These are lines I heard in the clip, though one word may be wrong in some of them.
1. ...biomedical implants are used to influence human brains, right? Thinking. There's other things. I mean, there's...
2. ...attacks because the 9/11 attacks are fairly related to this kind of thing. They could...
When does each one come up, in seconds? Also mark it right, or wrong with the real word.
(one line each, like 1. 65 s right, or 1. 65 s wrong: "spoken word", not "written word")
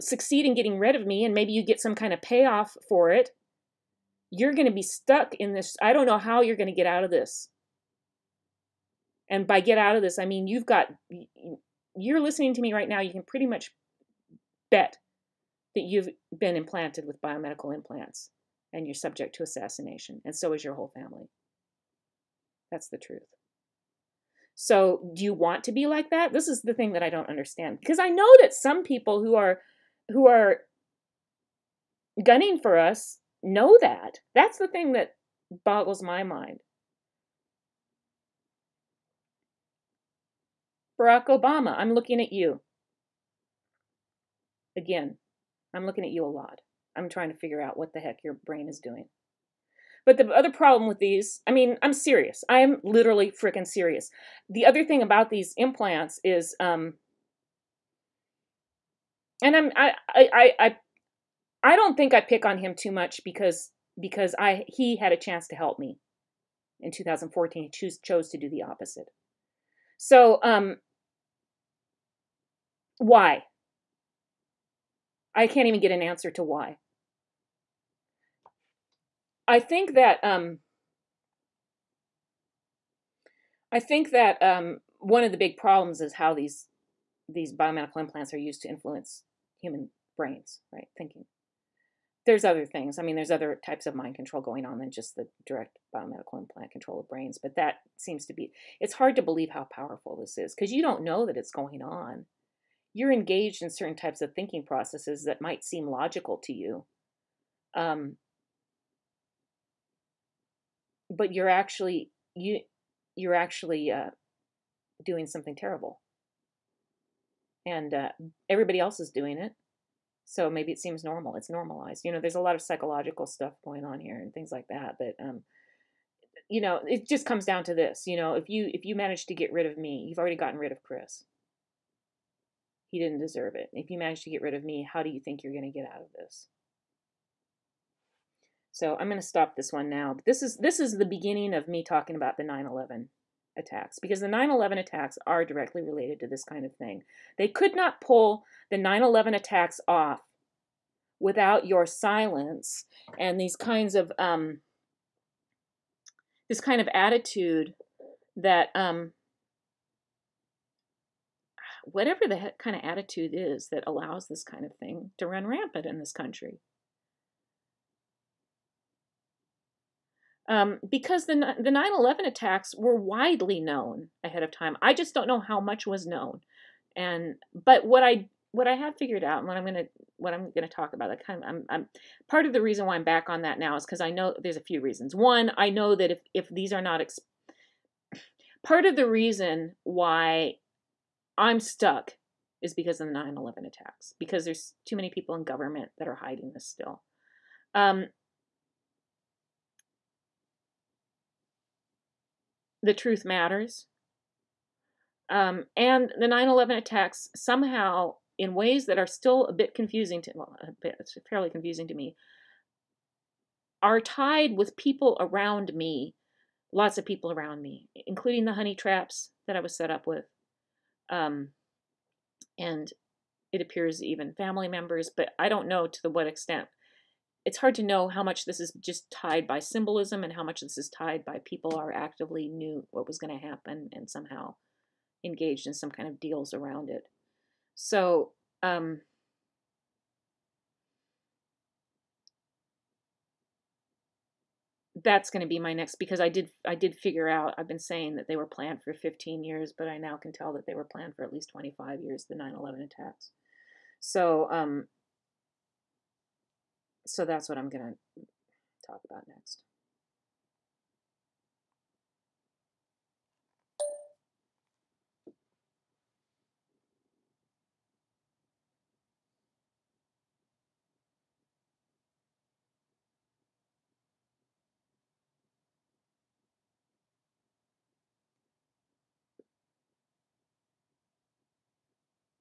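1. 87 s right
2. 143 s wrong: "directly", not "fairly".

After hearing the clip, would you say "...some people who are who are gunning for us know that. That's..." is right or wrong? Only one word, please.
right.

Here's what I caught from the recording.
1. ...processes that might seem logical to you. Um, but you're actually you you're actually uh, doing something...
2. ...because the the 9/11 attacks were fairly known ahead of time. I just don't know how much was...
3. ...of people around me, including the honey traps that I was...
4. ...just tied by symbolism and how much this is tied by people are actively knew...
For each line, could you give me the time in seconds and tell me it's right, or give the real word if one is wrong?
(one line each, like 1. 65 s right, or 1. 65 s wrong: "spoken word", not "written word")
1. 104 s right
2. 170 s wrong: "widely", not "fairly"
3. 216 s right
4. 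228 s right.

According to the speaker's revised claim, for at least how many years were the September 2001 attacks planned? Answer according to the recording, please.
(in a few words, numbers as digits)
25 years.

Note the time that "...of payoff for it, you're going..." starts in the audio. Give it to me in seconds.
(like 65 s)
2 s.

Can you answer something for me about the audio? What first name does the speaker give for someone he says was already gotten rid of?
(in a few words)
Chris.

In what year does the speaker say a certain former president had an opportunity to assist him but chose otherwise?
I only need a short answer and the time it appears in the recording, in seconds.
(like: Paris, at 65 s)
2014, at 66 s.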